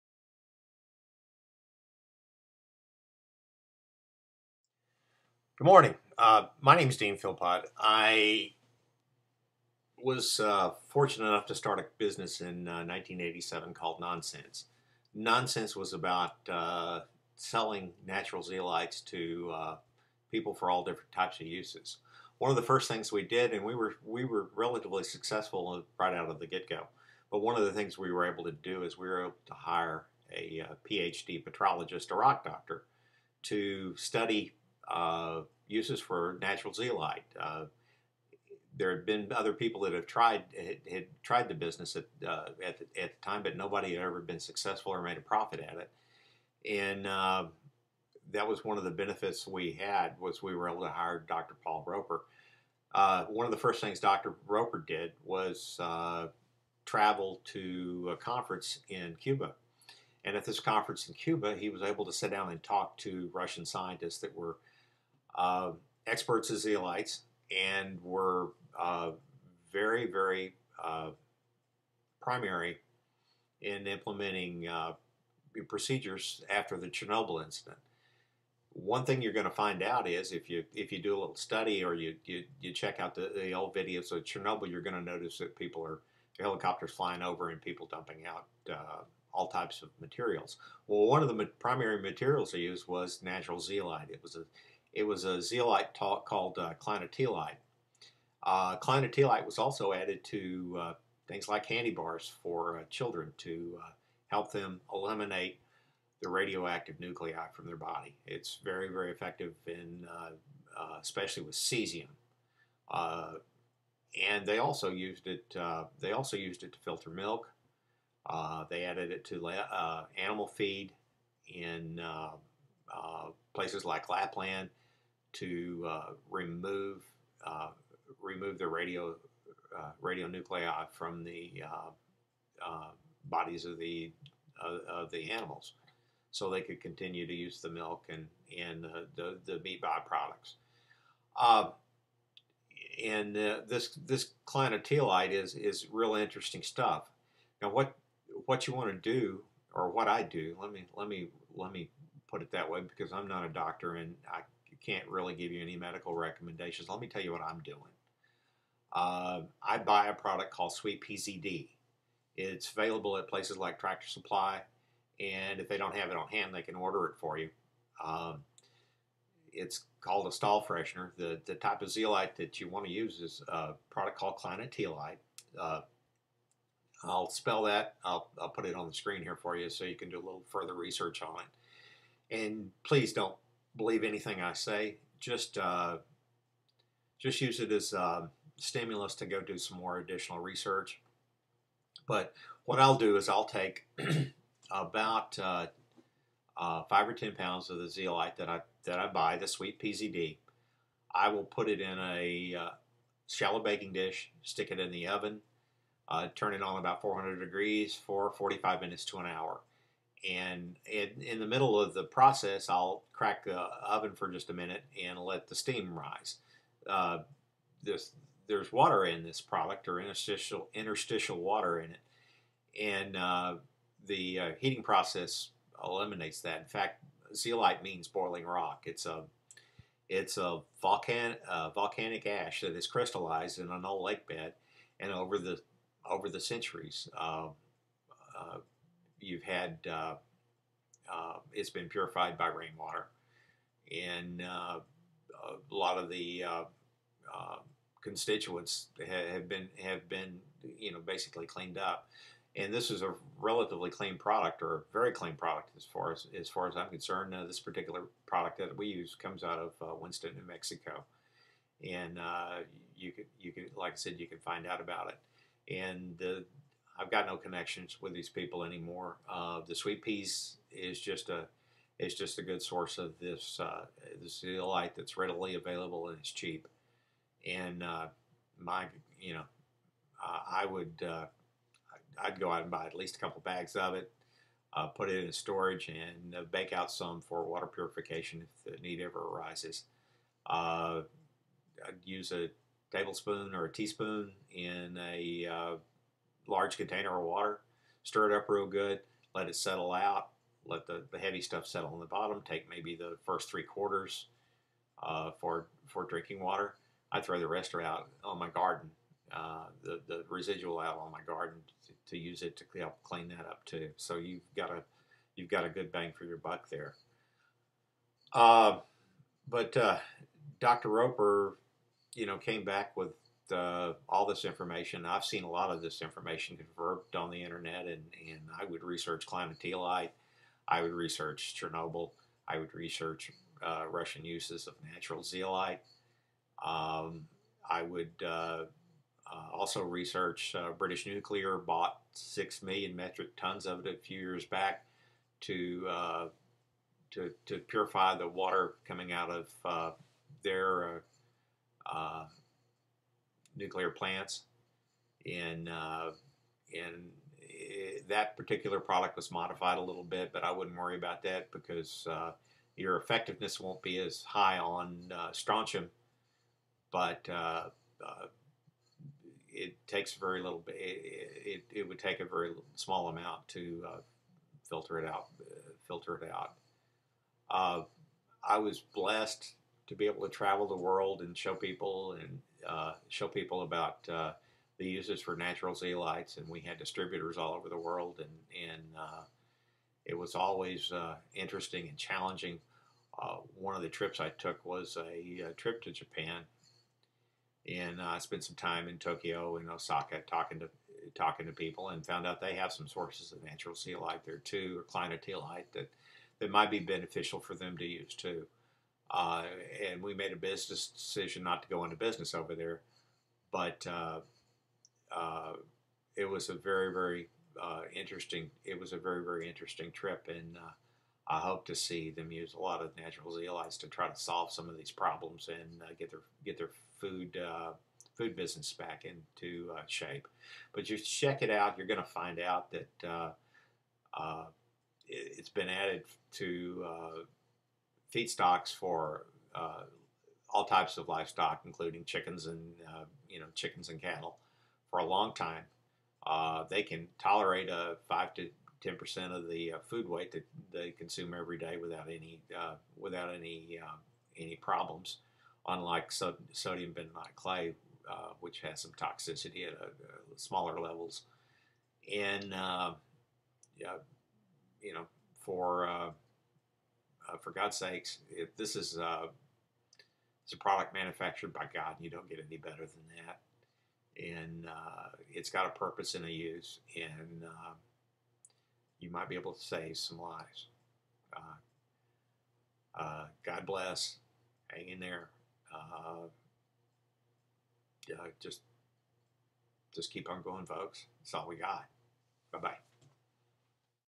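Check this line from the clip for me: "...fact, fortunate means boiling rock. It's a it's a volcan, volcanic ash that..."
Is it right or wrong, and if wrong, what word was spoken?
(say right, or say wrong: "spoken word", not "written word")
wrong: "zeolite", not "fortunate".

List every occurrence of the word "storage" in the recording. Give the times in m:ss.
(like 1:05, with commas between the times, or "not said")
4:45.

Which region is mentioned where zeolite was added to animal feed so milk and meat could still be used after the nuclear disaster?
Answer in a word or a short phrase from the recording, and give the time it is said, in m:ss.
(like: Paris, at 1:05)
Lapland, at 2:04.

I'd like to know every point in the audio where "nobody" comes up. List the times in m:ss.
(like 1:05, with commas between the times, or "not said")
0:43.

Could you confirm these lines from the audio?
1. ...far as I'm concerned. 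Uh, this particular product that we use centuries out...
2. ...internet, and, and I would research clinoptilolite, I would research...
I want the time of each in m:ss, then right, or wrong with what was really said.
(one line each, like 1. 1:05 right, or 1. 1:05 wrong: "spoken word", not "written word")
1. 4:16 wrong: "comes", not "centuries"
2. 5:27 right.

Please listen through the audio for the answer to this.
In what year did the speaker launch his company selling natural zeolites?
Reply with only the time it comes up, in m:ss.
0:12.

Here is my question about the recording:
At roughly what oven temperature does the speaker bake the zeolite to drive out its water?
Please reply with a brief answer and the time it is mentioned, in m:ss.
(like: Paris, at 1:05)
400 degrees, at 3:27.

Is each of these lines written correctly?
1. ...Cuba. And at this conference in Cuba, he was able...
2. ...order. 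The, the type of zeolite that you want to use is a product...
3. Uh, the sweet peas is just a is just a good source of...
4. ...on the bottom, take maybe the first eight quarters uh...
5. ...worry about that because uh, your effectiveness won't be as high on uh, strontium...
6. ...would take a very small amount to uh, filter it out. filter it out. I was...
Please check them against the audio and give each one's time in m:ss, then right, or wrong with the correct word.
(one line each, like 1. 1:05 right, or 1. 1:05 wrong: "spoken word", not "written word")
1. 0:59 right
2. 2:50 wrong: "freshener", not "order"
3. 4:29 right
4. 5:01 wrong: "three", not "eight"
5. 6:00 right
6. 6:11 right.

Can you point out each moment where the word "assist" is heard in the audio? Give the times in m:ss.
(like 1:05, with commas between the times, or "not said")
not said.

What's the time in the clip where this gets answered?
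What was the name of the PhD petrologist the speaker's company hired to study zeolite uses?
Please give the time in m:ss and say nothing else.
0:51.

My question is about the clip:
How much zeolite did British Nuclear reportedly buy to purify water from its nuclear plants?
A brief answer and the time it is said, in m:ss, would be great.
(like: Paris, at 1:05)
6 million metric tons, at 5:42.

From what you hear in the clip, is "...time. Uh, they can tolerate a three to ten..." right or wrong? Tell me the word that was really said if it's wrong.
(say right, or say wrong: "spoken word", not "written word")
wrong: "five", not "three".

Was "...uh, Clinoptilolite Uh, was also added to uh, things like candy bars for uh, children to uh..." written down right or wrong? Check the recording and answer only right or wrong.
right.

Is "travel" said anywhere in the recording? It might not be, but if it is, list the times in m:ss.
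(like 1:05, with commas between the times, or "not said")
0:56, 6:20.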